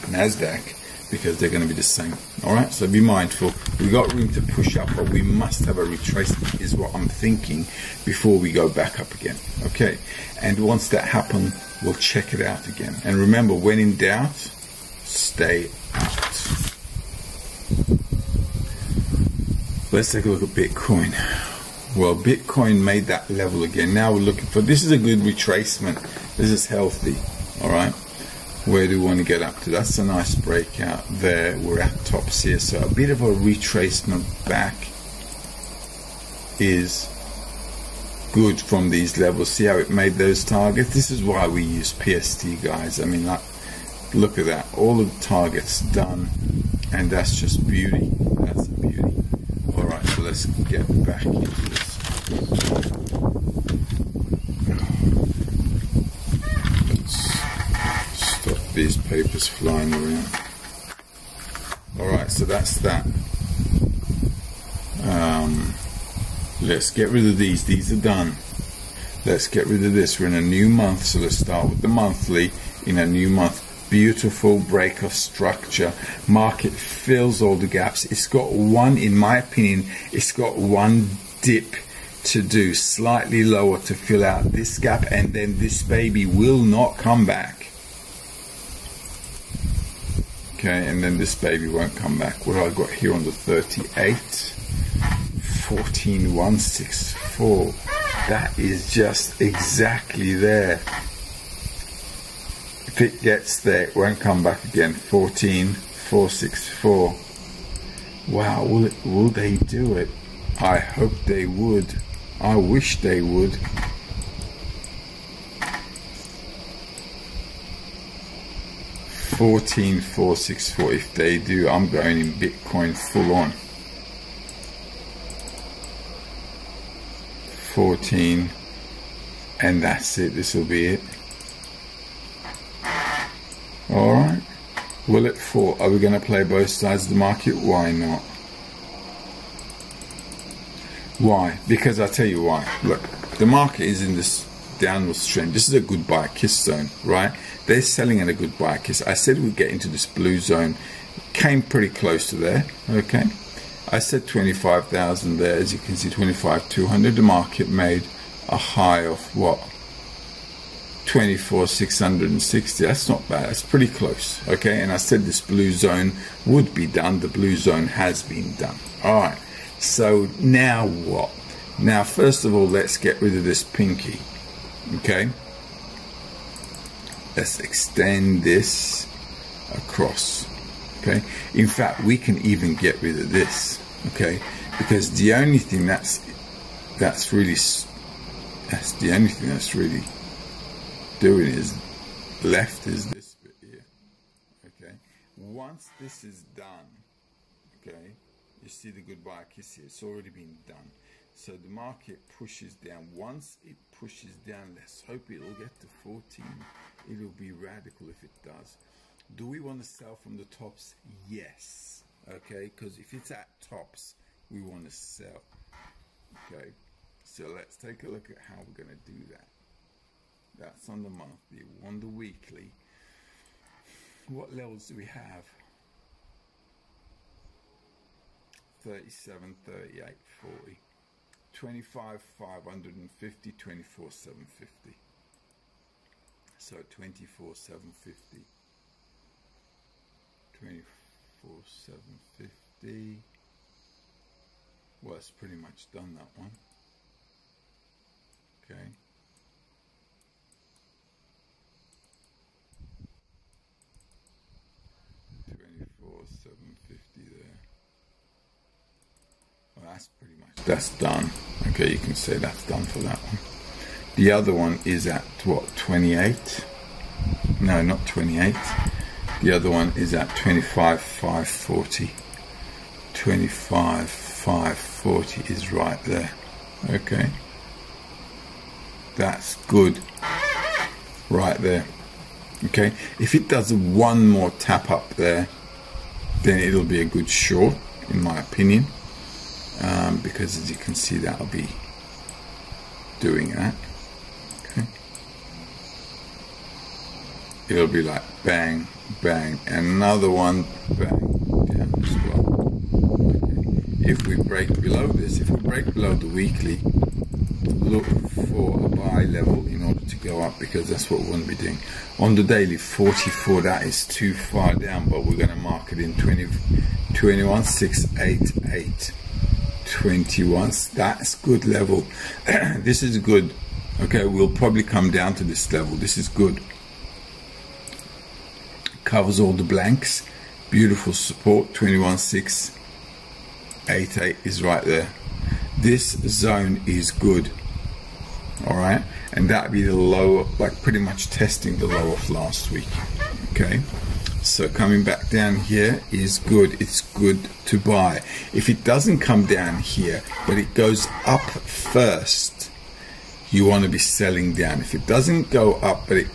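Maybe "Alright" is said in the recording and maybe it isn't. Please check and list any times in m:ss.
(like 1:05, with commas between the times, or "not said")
1:01, 5:38.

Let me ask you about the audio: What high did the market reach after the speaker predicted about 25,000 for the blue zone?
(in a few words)
24,660.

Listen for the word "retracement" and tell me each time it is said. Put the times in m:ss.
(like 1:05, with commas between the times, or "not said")
0:05, 0:25, 0:33.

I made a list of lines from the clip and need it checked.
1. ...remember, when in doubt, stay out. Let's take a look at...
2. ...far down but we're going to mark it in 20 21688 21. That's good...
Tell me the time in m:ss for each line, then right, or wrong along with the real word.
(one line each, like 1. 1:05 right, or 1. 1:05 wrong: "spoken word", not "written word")
1. 0:13 right
2. 5:14 right.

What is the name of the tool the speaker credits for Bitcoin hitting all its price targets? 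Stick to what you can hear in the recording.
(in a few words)
PST.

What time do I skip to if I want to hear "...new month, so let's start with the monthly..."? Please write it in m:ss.
1:10.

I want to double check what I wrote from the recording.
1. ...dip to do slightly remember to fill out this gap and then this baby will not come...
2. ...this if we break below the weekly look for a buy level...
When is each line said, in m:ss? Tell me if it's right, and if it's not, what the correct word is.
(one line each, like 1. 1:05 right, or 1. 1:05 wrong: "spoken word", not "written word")
1. 1:21 wrong: "lower", not "remember"
2. 5:05 right.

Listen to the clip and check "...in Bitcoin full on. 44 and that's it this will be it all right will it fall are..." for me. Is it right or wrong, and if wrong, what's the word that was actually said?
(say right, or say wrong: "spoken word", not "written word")
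wrong: "14", not "44".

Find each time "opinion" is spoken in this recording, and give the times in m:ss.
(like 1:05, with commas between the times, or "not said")
1:19, 4:48.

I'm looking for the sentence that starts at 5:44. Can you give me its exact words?
So coming back down here is good.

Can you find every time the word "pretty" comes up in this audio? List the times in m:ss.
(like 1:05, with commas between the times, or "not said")
2:31, 2:43, 4:20, 5:40.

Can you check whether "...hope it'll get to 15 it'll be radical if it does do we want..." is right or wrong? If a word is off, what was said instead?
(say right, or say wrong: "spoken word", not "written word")
wrong: "14", not "15".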